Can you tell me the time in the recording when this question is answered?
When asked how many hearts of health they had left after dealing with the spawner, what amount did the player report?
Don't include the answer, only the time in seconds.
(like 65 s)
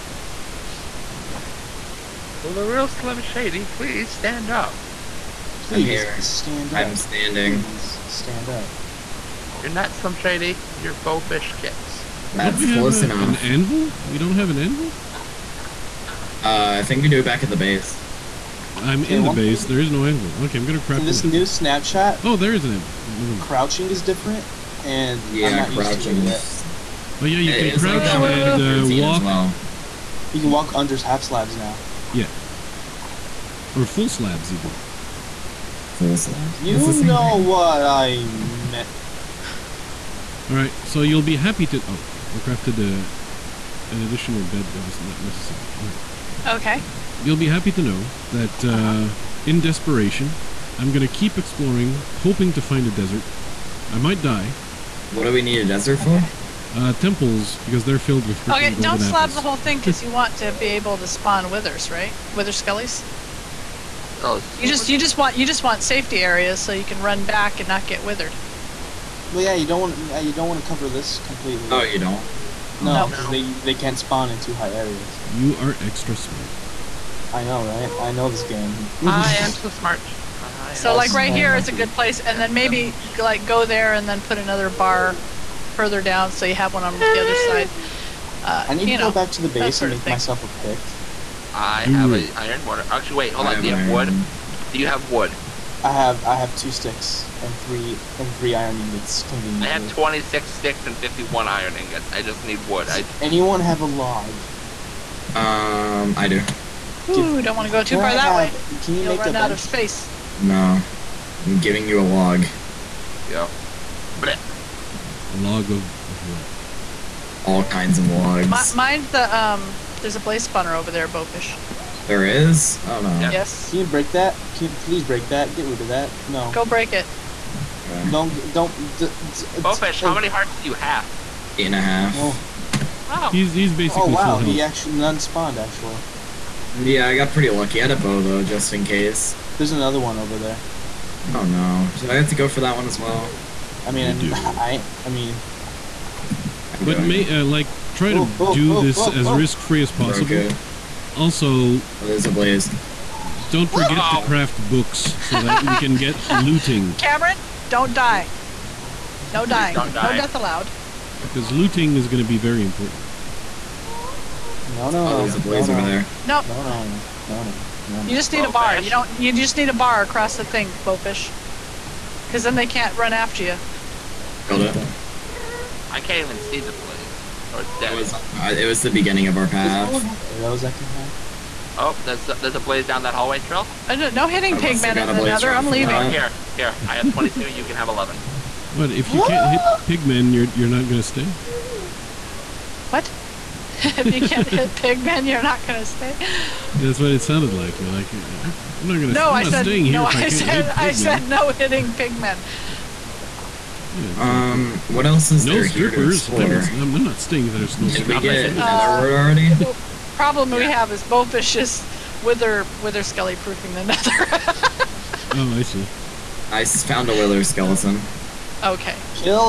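131 s.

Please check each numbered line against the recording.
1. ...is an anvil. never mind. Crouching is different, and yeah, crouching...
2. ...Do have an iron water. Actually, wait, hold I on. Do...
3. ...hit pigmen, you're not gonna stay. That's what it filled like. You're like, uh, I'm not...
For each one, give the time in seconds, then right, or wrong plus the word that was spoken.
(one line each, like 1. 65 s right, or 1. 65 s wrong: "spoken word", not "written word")
1. 22 s right
2. 91 s right
3. 194 s wrong: "sounded", not "filled".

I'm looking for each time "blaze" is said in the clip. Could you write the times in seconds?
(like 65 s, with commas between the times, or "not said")
120 s, 152 s, 165 s, 176 s, 182 s.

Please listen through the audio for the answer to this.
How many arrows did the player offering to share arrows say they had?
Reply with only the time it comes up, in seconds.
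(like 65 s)
187 s.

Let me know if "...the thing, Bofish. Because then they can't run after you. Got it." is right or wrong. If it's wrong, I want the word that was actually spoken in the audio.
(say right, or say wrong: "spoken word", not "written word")
right.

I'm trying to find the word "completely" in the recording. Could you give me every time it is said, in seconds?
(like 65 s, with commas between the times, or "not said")
71 s.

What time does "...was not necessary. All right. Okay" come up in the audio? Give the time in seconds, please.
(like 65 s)
44 s.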